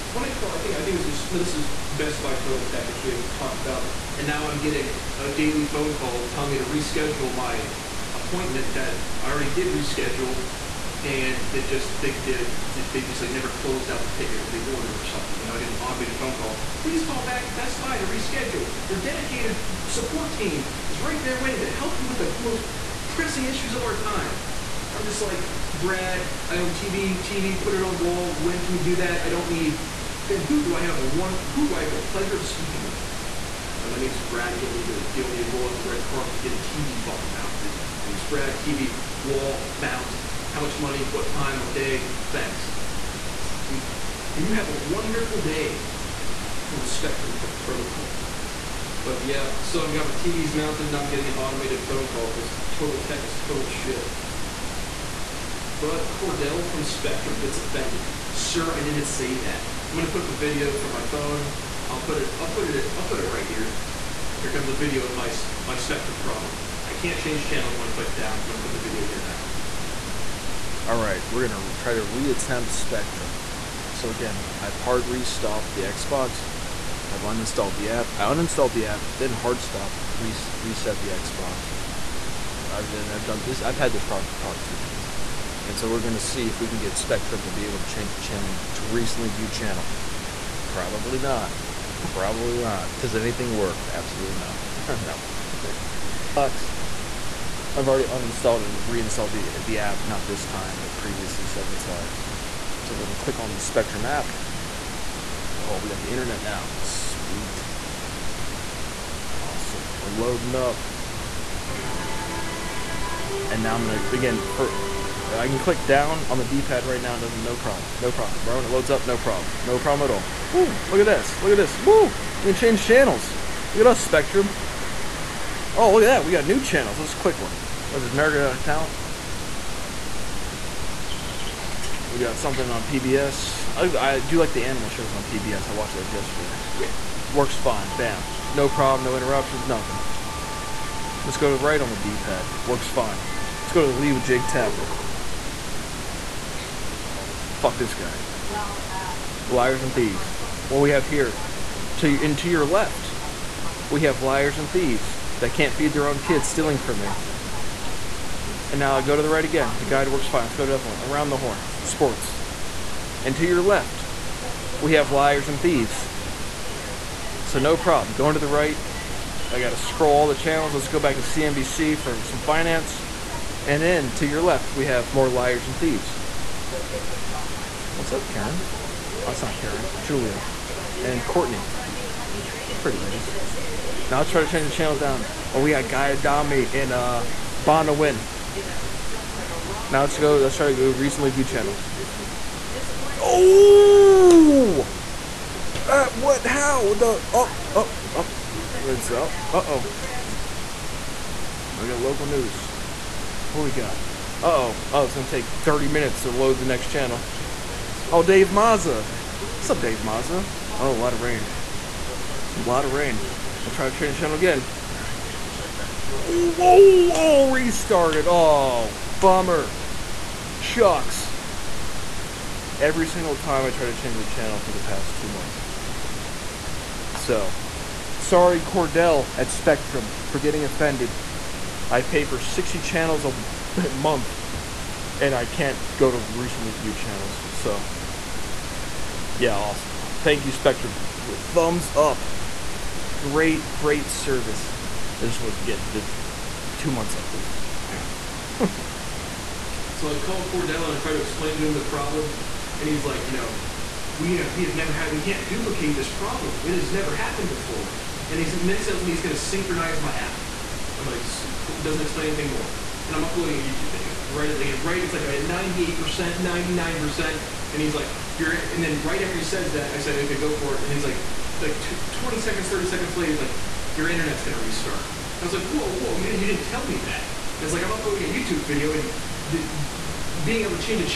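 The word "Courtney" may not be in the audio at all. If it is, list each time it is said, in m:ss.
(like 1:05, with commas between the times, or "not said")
3:01.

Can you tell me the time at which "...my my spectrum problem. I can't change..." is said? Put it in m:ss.
1:05.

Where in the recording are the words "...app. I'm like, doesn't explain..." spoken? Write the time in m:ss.
4:20.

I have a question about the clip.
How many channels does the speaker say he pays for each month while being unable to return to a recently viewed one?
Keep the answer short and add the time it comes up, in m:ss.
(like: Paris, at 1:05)
60, at 3:52.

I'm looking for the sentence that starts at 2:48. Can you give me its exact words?
Going to the right, I got to scroll all the channels.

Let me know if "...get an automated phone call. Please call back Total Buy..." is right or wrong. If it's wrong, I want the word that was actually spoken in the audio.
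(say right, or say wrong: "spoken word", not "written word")
wrong: "Best", not "Total".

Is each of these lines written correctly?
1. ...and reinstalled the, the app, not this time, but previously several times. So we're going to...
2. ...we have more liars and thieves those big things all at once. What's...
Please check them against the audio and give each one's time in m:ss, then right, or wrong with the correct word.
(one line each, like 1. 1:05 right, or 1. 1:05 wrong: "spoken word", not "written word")
1. 1:38 right
2. 2:54 right.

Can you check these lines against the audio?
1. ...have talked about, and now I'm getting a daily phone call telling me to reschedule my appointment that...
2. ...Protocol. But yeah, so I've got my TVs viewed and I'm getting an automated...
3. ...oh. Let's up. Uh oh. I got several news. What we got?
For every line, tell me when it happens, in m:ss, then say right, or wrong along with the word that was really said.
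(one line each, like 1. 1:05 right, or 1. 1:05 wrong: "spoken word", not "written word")
1. 0:03 right
2. 0:47 wrong: "mounted", not "viewed"
3. 3:18 wrong: "local", not "several".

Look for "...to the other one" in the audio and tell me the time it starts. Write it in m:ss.
2:40.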